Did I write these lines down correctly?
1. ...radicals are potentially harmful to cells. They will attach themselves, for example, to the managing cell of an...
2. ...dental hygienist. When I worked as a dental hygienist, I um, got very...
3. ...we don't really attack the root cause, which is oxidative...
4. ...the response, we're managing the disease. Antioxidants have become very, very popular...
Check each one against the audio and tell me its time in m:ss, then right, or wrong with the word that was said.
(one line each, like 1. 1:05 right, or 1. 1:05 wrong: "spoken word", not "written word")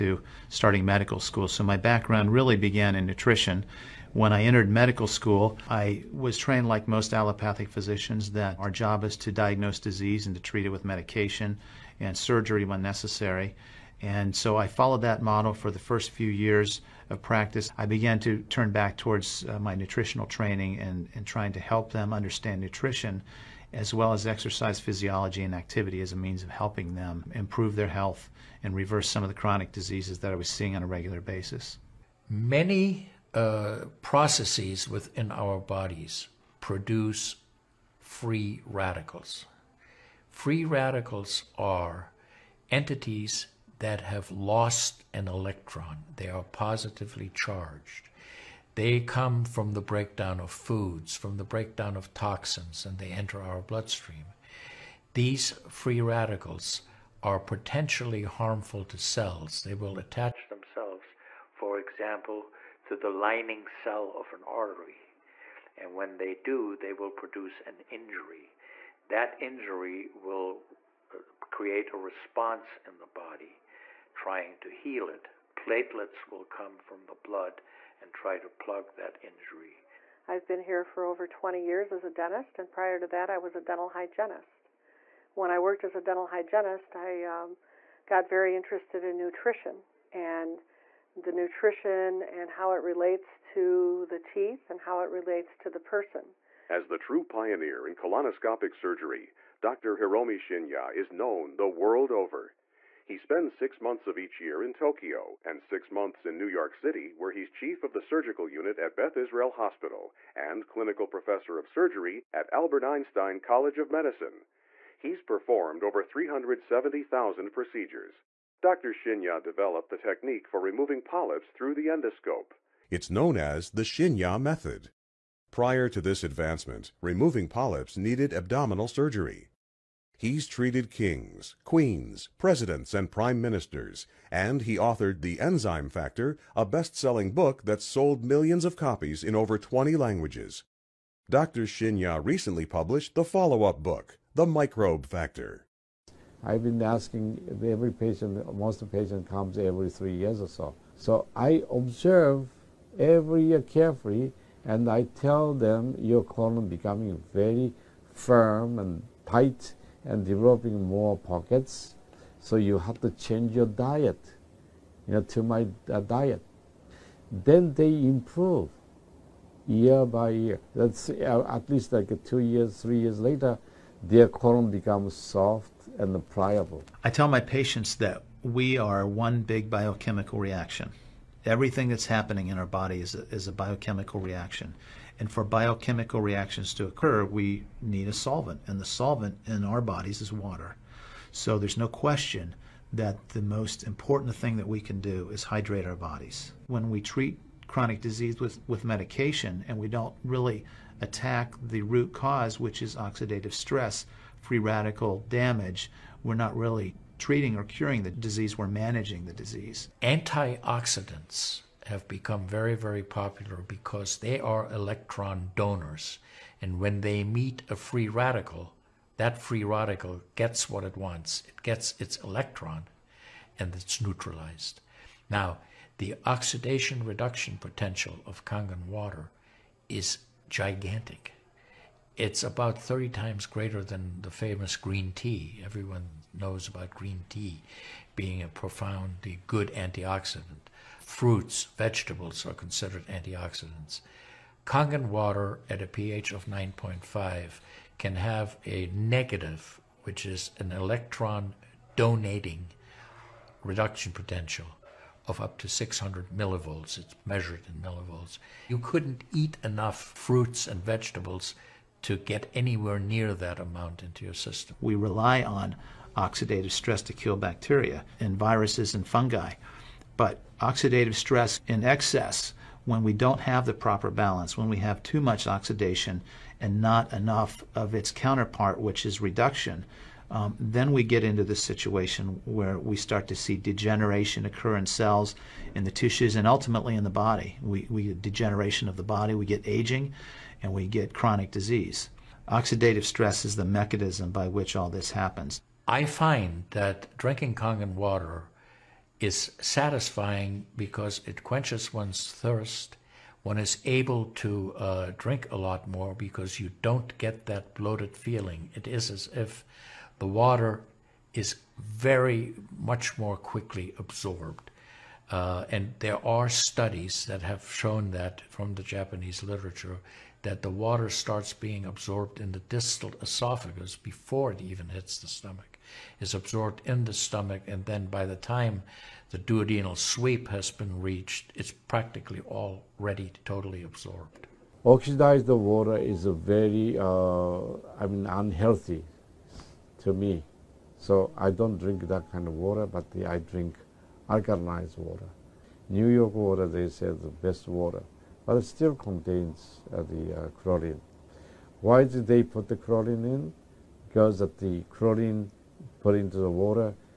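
1. 0:56 wrong: "lining", not "managing"
2. 1:23 right
3. 3:19 right
4. 3:28 wrong: "disease", not "response".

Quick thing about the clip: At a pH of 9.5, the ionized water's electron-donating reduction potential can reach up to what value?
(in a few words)
600 millivolts.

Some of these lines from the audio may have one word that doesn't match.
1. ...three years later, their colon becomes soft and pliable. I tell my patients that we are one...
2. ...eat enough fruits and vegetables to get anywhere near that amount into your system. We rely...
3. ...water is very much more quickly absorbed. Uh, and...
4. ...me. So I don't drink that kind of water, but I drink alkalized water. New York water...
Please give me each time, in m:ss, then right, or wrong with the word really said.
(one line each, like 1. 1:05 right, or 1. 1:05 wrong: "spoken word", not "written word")
1. 2:52 right
2. 4:19 right
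3. 5:10 right
4. 5:40 right.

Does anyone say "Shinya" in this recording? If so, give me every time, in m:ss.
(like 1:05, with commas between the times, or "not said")
1:40, 1:58, 2:03, 2:21.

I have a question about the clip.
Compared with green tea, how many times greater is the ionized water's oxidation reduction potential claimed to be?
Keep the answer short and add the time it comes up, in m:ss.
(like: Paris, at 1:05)
30, at 3:52.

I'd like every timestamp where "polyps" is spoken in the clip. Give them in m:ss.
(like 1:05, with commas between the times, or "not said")
2:01, 2:07.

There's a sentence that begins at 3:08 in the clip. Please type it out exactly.
And the solvent in our bodies is water.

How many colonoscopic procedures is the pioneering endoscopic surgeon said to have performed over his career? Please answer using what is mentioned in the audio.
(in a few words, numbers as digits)
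370,000.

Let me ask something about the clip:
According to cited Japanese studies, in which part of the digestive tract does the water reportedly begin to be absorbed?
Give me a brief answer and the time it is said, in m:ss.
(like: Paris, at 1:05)
distal esophagus, at 5:22.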